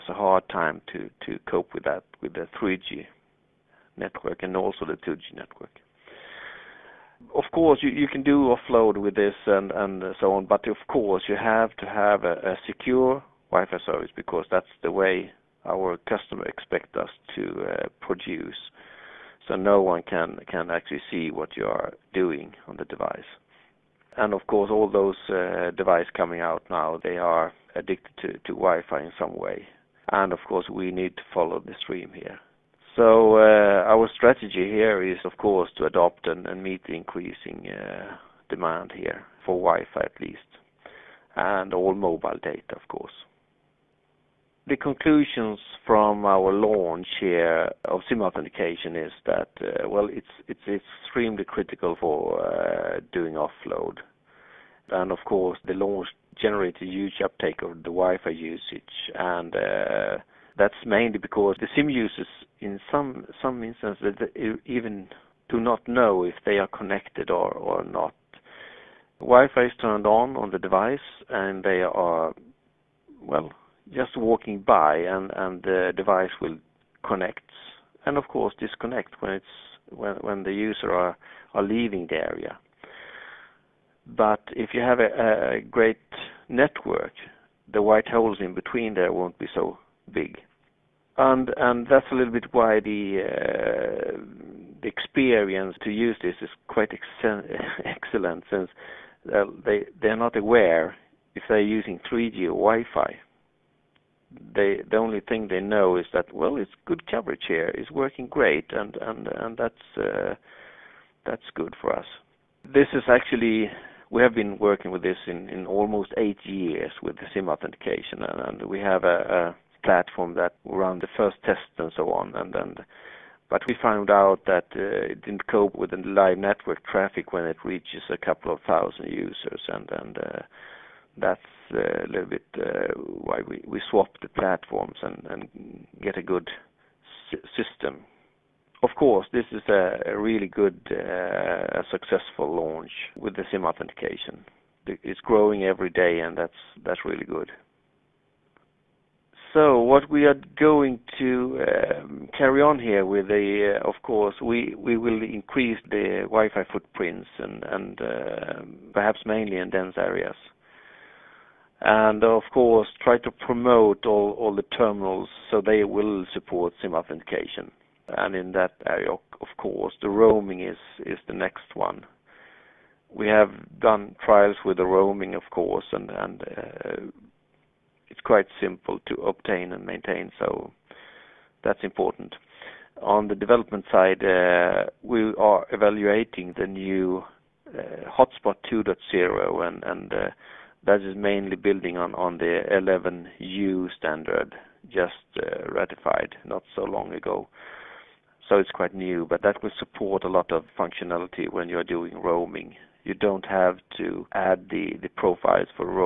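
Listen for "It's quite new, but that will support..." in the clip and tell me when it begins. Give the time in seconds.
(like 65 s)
198 s.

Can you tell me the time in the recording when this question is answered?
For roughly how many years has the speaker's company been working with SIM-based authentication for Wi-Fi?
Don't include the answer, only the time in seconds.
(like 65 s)
116 s.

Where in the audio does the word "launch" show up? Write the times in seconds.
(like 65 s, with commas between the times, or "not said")
46 s, 55 s, 142 s.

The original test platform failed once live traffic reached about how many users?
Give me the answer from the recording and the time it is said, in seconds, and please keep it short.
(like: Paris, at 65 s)
a couple of thousand, at 128 s.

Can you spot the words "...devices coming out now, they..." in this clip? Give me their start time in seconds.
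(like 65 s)
25 s.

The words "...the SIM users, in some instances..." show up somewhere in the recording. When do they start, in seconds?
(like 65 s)
61 s.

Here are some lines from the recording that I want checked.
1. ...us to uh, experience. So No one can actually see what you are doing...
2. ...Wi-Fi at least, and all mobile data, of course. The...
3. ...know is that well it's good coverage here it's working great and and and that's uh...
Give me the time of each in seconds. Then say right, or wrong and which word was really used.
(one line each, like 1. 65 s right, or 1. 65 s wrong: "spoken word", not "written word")
1. 16 s wrong: "produce", not "experience"
2. 39 s right
3. 105 s right.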